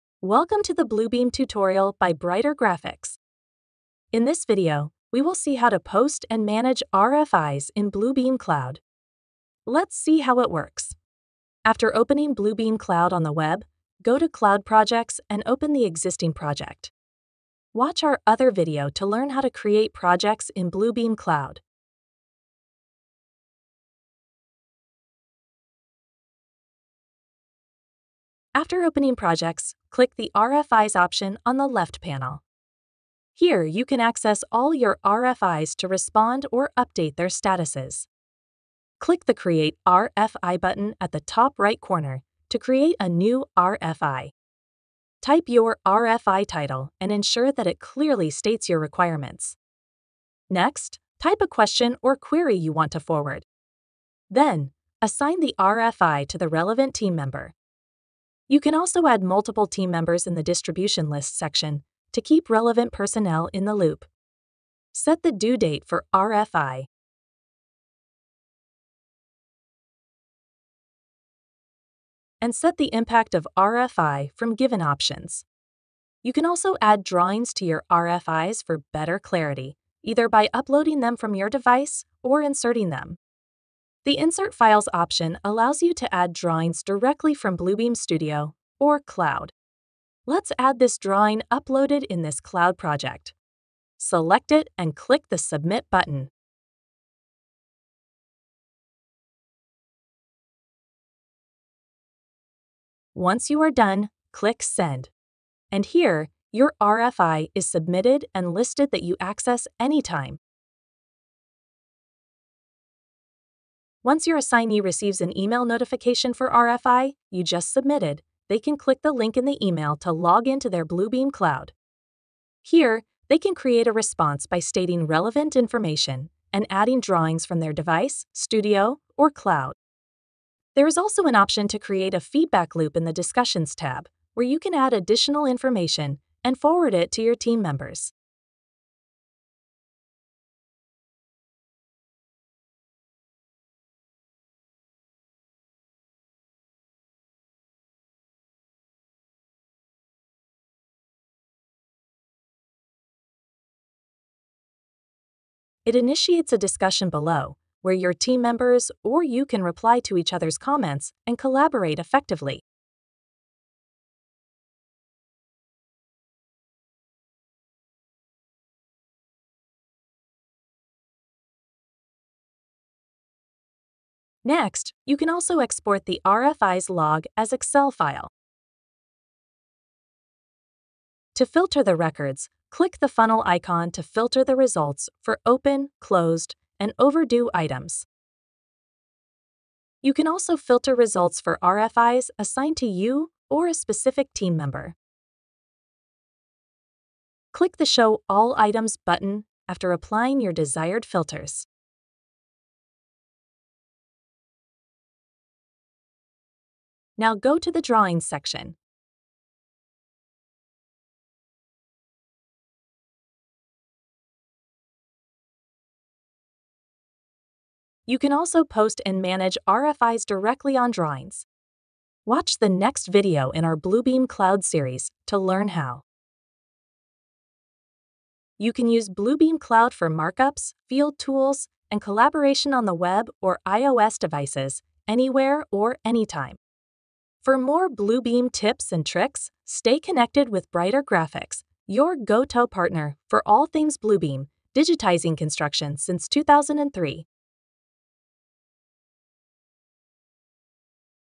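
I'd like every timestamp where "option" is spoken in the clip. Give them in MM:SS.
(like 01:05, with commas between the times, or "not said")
00:30, 01:14, 01:24, 02:11.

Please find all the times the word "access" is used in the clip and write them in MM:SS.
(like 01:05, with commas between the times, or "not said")
00:34, 01:49.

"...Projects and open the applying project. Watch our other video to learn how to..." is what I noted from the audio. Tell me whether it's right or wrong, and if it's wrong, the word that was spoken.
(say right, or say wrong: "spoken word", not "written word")
wrong: "existing", not "applying".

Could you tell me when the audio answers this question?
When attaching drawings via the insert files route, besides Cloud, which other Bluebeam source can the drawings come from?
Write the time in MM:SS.
01:27.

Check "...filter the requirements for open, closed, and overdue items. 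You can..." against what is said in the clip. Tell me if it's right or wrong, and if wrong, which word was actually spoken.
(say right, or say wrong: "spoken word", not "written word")
wrong: "results", not "requirements".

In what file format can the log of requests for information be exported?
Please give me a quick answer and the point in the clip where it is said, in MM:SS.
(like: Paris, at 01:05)
Excel, at 02:57.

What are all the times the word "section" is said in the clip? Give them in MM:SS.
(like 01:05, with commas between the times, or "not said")
01:01, 03:28.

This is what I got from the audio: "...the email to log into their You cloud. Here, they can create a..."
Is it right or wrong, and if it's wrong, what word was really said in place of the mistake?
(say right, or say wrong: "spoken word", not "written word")
wrong: "Bluebeam", not "You".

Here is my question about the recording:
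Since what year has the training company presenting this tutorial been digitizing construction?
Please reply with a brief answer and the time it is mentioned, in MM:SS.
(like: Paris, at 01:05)
2003, at 04:06.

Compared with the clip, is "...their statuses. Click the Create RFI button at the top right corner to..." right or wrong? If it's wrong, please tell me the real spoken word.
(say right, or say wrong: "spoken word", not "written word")
right.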